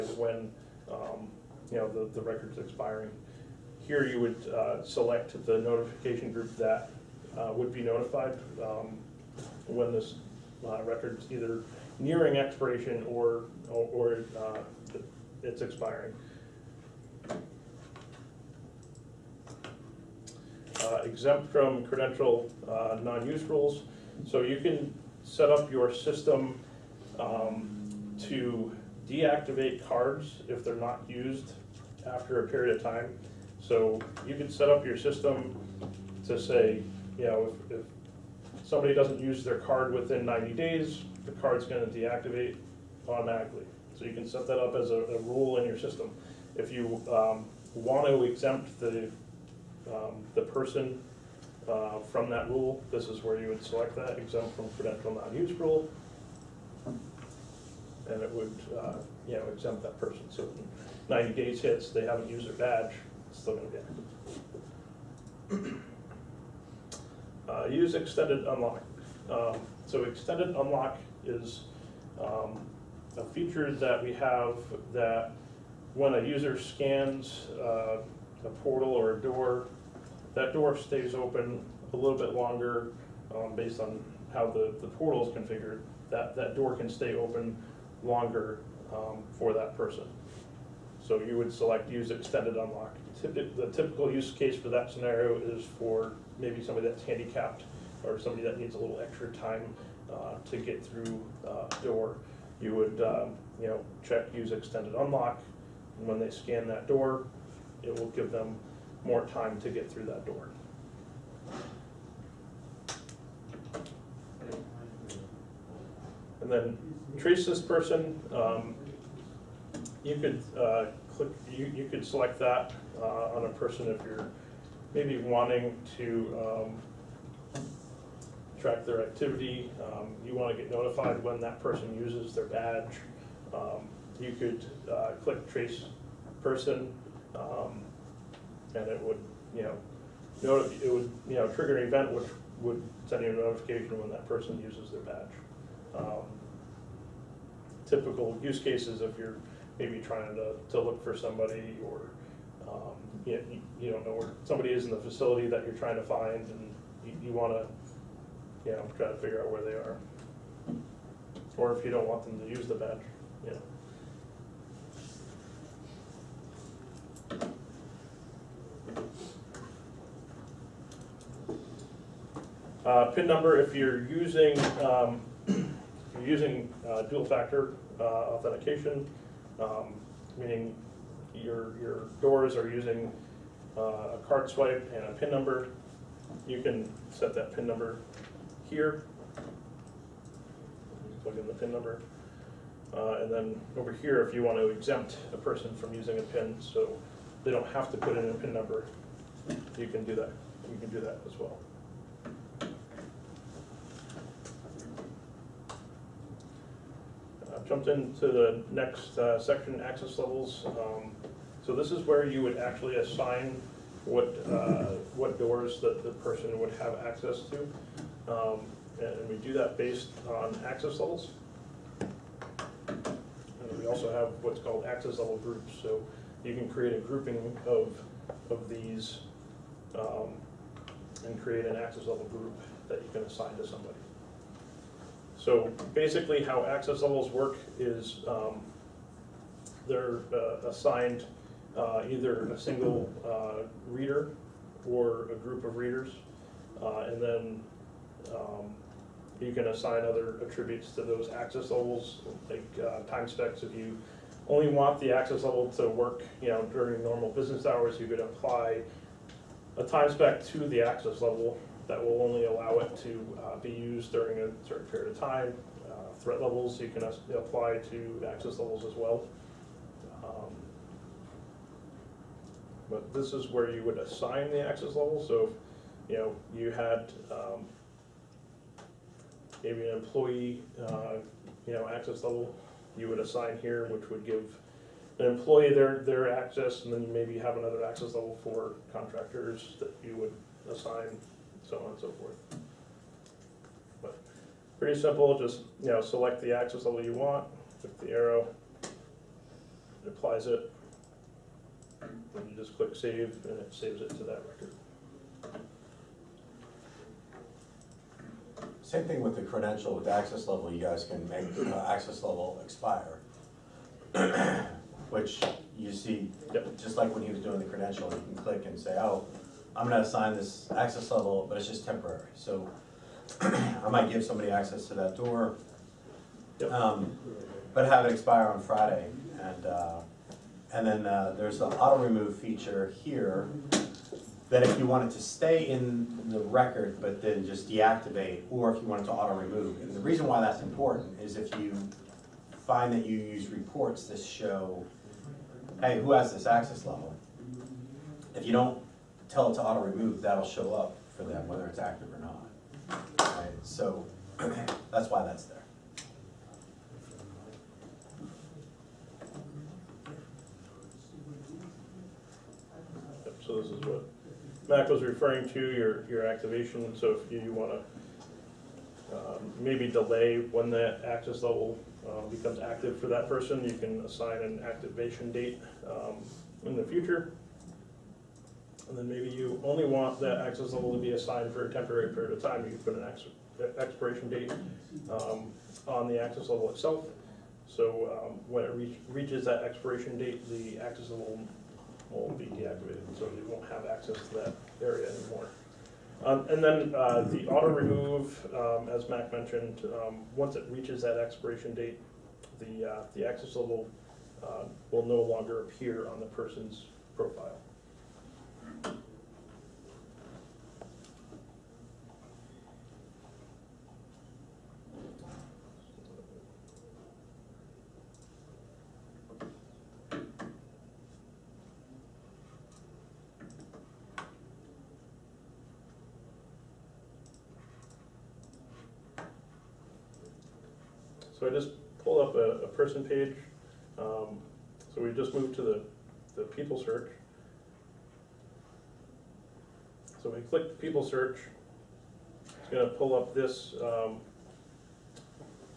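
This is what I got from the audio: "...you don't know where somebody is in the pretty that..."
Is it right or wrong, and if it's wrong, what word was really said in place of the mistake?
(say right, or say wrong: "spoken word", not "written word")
wrong: "facility", not "pretty".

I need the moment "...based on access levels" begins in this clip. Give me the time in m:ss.
3:39.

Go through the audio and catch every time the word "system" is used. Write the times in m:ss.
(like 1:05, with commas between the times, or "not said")
0:25, 0:34, 0:45.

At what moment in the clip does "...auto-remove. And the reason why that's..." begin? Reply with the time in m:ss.
5:39.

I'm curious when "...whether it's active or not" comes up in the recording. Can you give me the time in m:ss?
5:51.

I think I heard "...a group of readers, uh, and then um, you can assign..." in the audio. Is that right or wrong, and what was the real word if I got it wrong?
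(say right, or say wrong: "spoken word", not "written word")
right.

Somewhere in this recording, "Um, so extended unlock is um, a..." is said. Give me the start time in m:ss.
1:09.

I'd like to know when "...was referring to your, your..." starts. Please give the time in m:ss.
6:04.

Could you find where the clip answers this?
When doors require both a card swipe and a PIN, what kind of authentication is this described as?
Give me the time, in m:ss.
2:57.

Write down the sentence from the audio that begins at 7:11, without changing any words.
So I just pulled up a, a person page.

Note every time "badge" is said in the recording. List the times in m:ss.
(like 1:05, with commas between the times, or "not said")
1:02, 2:12, 2:25, 2:42.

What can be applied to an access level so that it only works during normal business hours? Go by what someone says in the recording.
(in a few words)
Time specs.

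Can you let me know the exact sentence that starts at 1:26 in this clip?
That, that door can stay open longer um, for that person.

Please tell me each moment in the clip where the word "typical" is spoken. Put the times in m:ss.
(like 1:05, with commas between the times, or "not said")
1:33, 2:27.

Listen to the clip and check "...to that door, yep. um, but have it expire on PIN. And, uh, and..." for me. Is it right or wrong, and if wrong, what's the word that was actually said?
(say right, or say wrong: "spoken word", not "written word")
wrong: "Friday", not "PIN".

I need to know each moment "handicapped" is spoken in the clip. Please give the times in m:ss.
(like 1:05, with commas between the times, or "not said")
1:37.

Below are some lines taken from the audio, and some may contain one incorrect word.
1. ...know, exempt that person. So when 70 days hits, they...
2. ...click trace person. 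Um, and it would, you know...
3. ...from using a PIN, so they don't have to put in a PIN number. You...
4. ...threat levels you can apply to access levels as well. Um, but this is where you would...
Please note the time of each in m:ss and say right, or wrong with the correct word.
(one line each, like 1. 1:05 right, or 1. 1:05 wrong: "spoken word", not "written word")
1. 0:59 wrong: "90", not "70"
2. 2:15 right
3. 3:15 right
4. 4:26 right.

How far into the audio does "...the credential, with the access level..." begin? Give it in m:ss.
5:09.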